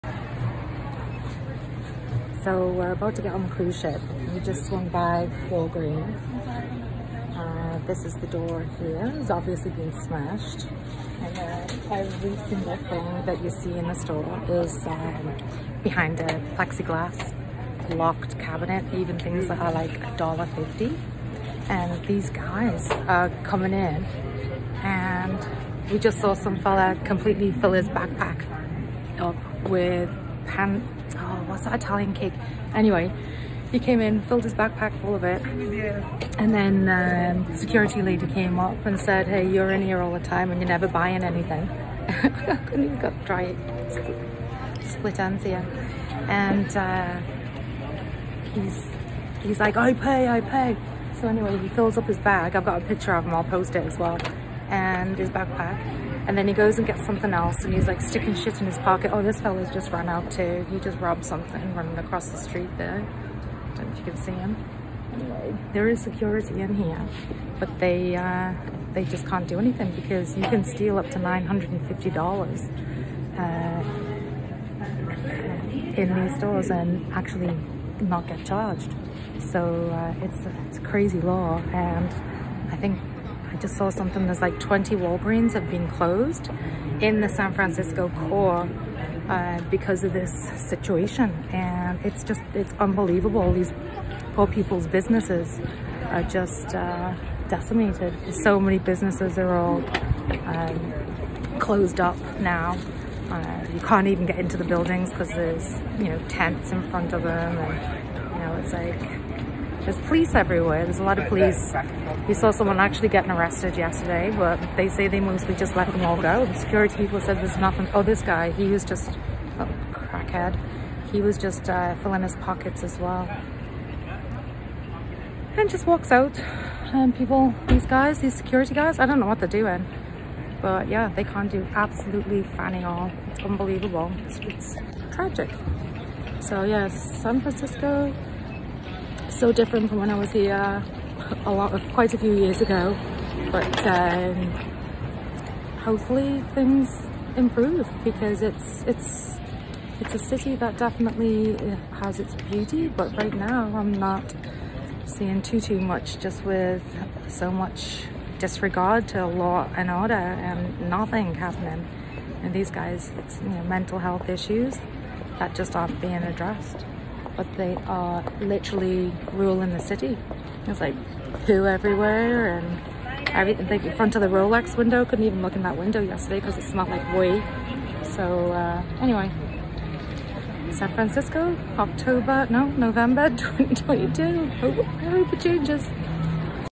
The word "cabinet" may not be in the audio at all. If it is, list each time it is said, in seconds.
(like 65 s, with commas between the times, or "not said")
18 s.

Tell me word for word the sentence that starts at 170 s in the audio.
It's like poo everywhere and everything.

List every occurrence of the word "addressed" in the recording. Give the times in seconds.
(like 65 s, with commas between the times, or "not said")
166 s.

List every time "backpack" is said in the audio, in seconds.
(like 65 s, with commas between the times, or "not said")
27 s, 34 s, 55 s.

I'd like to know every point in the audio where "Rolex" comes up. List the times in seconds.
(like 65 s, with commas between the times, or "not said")
174 s.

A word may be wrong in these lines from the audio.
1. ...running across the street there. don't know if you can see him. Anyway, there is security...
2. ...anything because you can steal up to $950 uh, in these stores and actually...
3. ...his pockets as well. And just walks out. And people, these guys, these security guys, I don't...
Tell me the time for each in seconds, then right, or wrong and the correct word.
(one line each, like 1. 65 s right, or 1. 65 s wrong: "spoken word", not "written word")
1. 61 s right
2. 69 s right
3. 122 s right.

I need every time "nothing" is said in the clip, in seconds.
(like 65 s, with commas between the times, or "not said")
117 s, 160 s.